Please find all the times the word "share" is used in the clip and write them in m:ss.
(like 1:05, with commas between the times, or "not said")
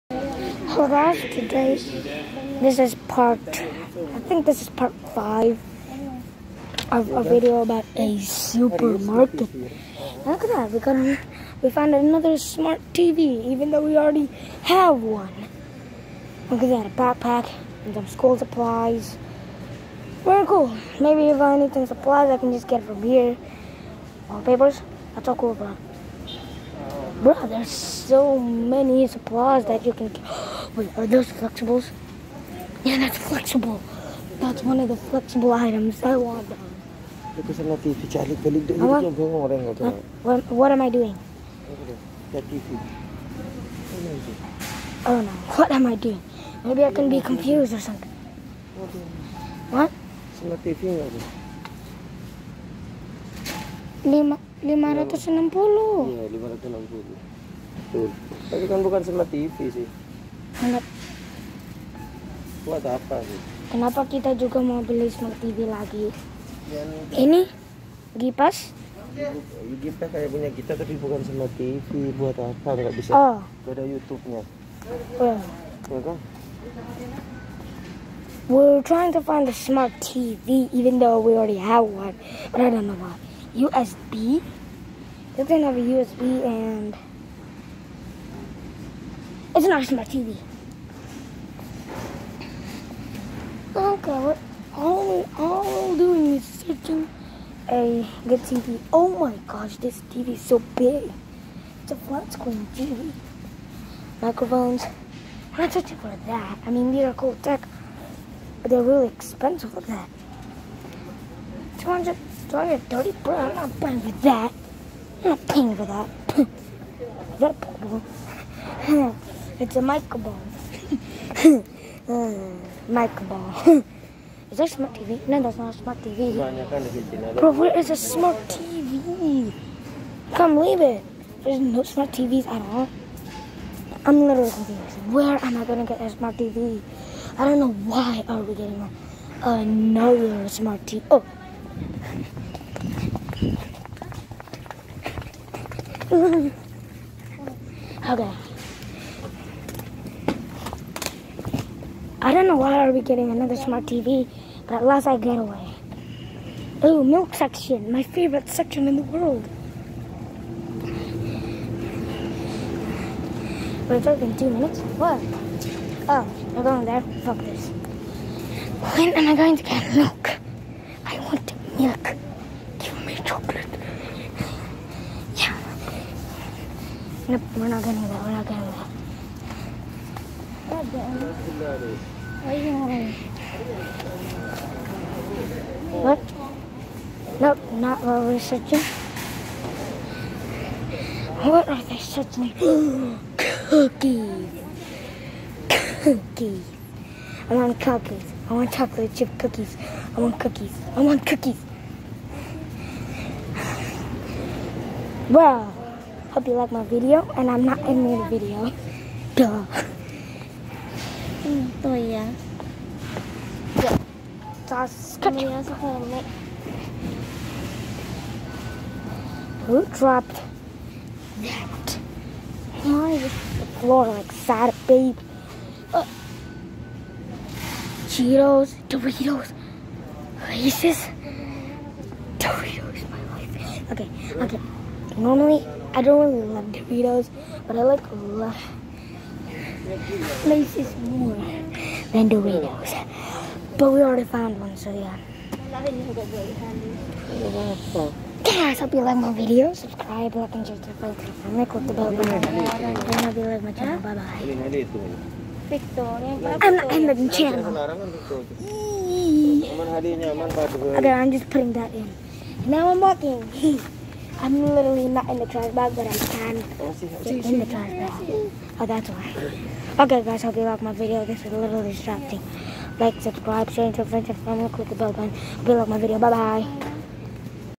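4:10, 4:33.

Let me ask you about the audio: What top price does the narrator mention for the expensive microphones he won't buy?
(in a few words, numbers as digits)
230.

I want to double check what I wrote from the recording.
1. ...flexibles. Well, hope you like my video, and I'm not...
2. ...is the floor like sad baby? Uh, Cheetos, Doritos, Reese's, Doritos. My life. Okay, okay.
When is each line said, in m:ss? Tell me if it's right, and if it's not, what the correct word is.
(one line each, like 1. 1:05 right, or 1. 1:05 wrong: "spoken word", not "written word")
1. 3:21 wrong: "cookies", not "flexibles"
2. 3:43 right.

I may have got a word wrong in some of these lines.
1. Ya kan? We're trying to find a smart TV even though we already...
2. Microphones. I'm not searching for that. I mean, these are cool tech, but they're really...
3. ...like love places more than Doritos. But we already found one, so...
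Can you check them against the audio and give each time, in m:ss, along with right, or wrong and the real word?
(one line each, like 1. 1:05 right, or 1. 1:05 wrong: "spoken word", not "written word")
1. 1:15 right
2. 1:44 right
3. 3:57 right.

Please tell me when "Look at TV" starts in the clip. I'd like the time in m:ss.
0:37.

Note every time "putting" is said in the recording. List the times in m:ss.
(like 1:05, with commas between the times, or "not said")
4:21.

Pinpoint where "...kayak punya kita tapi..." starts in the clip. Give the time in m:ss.
1:10.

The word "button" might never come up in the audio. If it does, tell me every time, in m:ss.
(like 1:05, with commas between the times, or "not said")
4:12, 4:35.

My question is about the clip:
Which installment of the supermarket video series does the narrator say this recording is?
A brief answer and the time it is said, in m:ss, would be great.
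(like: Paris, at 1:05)
Part 5, at 0:04.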